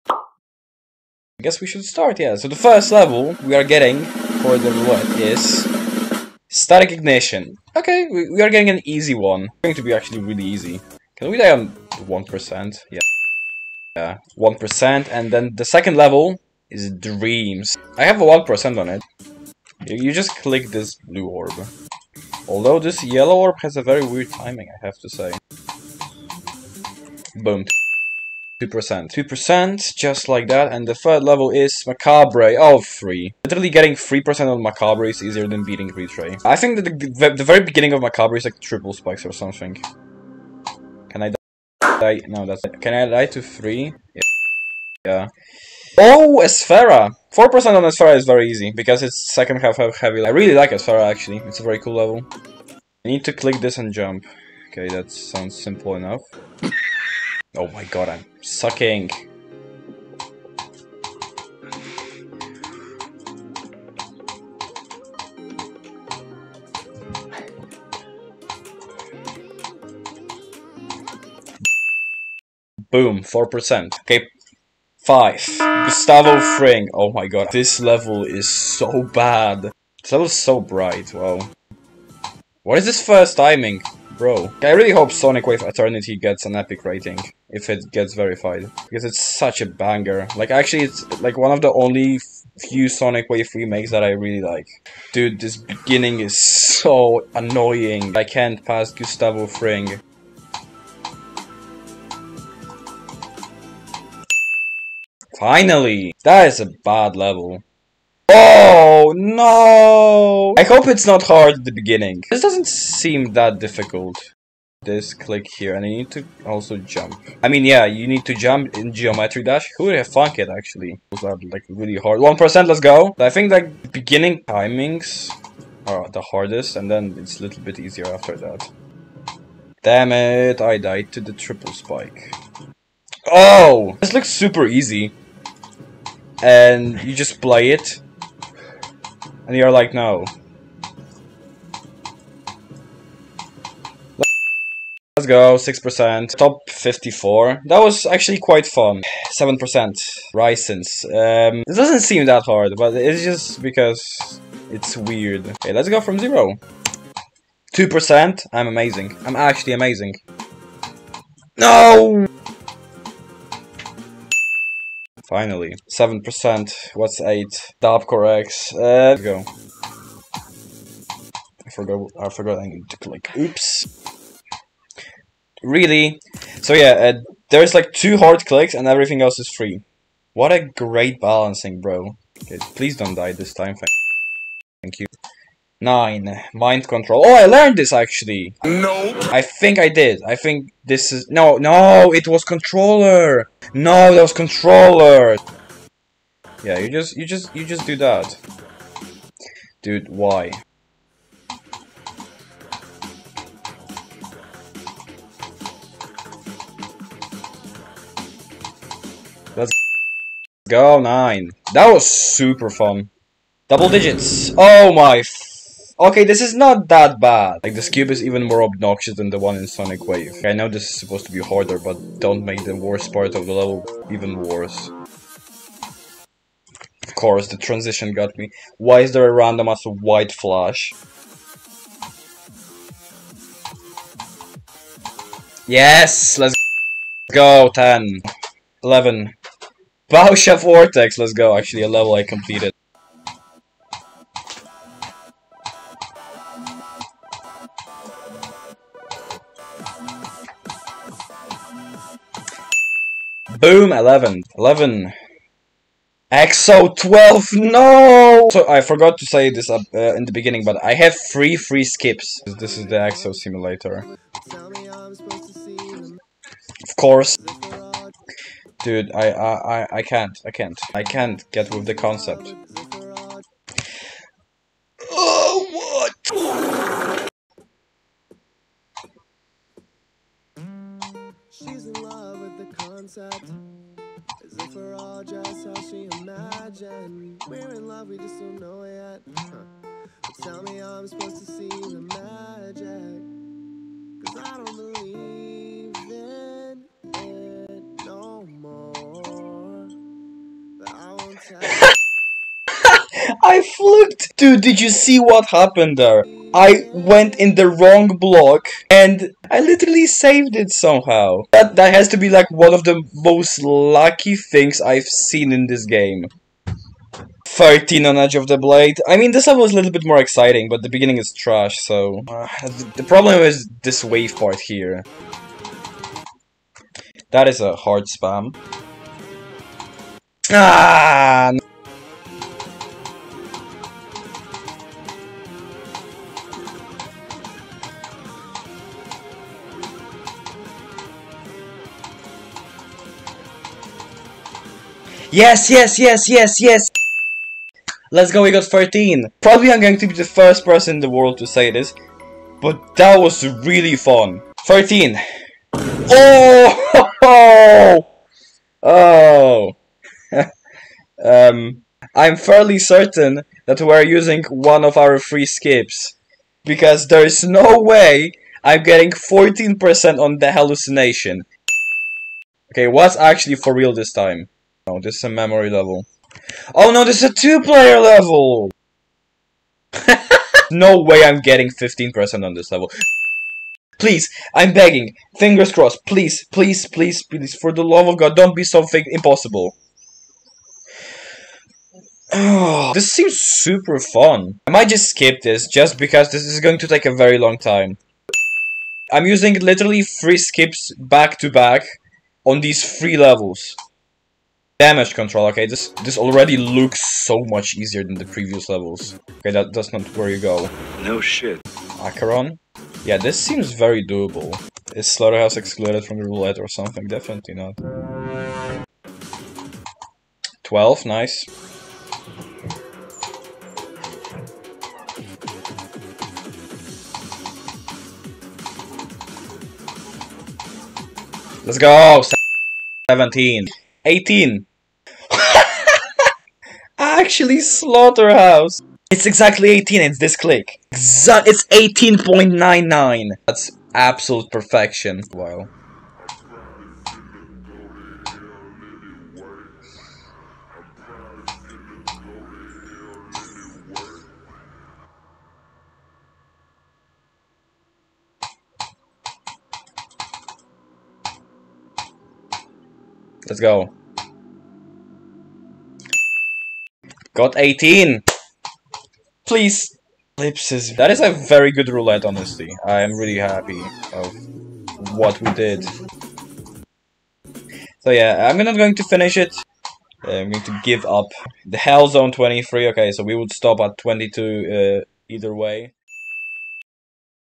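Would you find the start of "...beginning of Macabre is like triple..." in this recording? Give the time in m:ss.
0:37.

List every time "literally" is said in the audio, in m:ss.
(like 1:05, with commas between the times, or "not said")
0:33, 5:09, 6:39.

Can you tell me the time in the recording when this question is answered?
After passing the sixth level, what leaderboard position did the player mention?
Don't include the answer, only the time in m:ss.
2:26.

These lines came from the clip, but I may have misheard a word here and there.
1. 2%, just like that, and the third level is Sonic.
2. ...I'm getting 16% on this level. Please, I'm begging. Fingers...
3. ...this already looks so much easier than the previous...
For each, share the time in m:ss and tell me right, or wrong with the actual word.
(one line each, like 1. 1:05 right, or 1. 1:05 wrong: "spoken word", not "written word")
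1. 0:29 wrong: "Macabre", not "Sonic"
2. 6:21 wrong: "15", not "16"
3. 6:46 right.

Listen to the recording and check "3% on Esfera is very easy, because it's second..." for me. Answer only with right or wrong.
wrong.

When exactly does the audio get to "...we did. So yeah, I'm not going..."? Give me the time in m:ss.
7:55.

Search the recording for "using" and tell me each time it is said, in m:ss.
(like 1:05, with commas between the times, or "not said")
6:04, 6:39.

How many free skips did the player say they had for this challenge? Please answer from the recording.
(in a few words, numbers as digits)
3.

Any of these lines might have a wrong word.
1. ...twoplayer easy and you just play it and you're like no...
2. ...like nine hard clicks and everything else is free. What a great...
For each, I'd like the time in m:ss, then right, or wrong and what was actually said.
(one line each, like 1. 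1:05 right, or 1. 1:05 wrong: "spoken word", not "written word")
1. 2:14 wrong: "super", not "twoplayer"
2. 2:57 wrong: "two", not "nine".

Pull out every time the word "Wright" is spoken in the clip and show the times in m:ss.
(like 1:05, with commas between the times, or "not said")
not said.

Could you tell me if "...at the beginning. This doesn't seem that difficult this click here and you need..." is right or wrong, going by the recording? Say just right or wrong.
right.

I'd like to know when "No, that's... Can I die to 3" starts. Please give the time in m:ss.
0:42.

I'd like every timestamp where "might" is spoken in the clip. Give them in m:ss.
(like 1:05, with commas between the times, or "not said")
6:34.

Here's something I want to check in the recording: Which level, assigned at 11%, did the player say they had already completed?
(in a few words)
Bausha Vortex.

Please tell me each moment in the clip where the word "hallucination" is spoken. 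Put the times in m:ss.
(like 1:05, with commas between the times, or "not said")
6:10.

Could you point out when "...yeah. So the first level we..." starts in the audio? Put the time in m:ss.
0:02.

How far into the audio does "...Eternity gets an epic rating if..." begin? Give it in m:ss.
1:25.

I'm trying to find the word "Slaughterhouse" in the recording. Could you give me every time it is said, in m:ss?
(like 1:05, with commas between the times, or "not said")
6:55, 7:17.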